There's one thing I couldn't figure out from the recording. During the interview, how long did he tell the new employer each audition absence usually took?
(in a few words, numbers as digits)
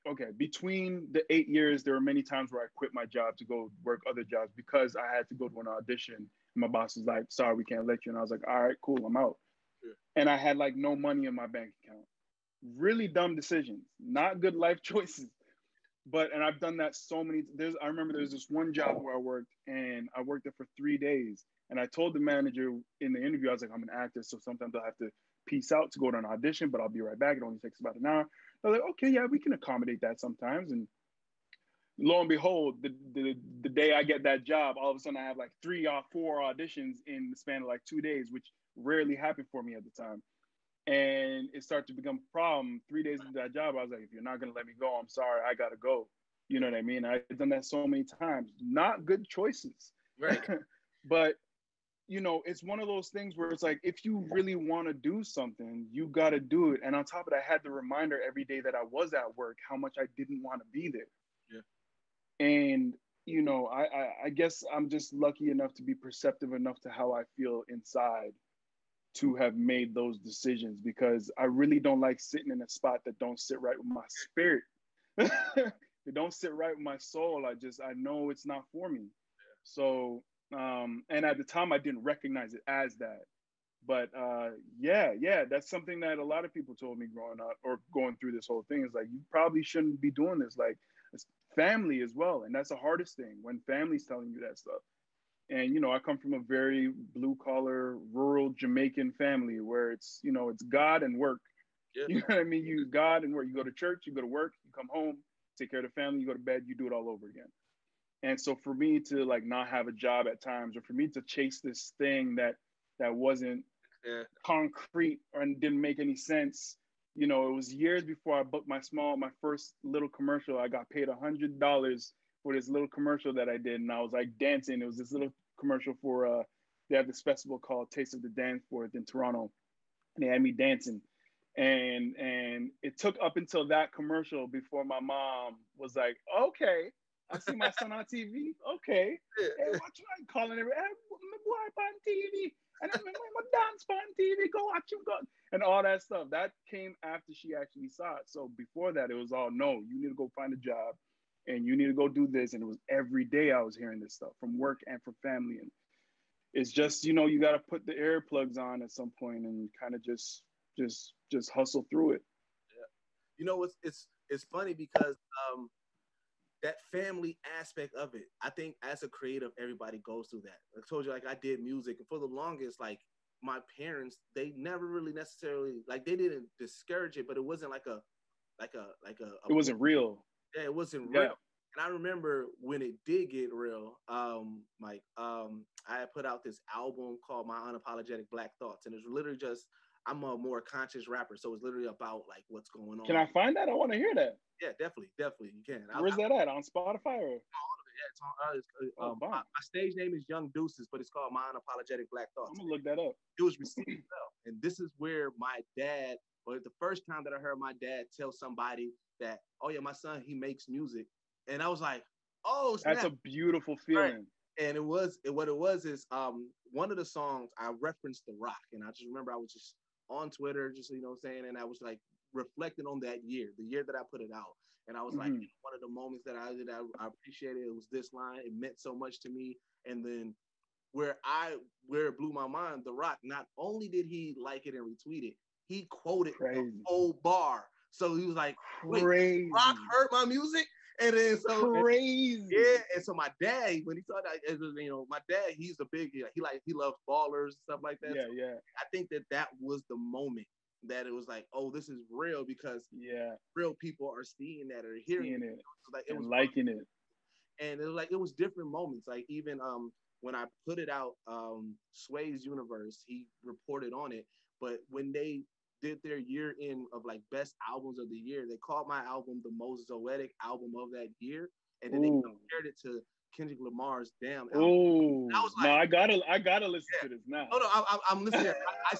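about an hour.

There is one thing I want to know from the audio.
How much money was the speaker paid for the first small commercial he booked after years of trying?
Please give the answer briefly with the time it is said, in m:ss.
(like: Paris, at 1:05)
$100, at 2:01.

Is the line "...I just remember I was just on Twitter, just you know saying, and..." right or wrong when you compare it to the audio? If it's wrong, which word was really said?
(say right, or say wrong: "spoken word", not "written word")
right.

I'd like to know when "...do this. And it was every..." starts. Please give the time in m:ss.
2:32.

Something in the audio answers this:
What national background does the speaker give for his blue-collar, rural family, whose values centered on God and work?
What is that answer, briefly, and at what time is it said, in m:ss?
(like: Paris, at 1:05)
Jamaican, at 1:38.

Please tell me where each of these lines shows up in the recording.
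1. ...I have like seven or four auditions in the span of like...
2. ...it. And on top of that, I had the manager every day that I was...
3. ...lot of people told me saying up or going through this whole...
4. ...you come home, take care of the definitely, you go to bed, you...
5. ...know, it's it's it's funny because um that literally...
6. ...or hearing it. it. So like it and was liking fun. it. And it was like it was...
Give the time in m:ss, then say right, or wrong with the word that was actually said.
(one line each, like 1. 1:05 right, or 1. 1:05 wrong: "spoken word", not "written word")
1. 0:35 wrong: "three", not "seven"
2. 0:56 wrong: "reminder", not "manager"
3. 1:26 wrong: "growing", not "saying"
4. 1:44 wrong: "family", not "definitely"
5. 2:43 wrong: "family", not "literally"
6. 4:14 right.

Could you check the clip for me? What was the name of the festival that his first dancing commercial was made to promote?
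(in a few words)
Taste of the Danforth.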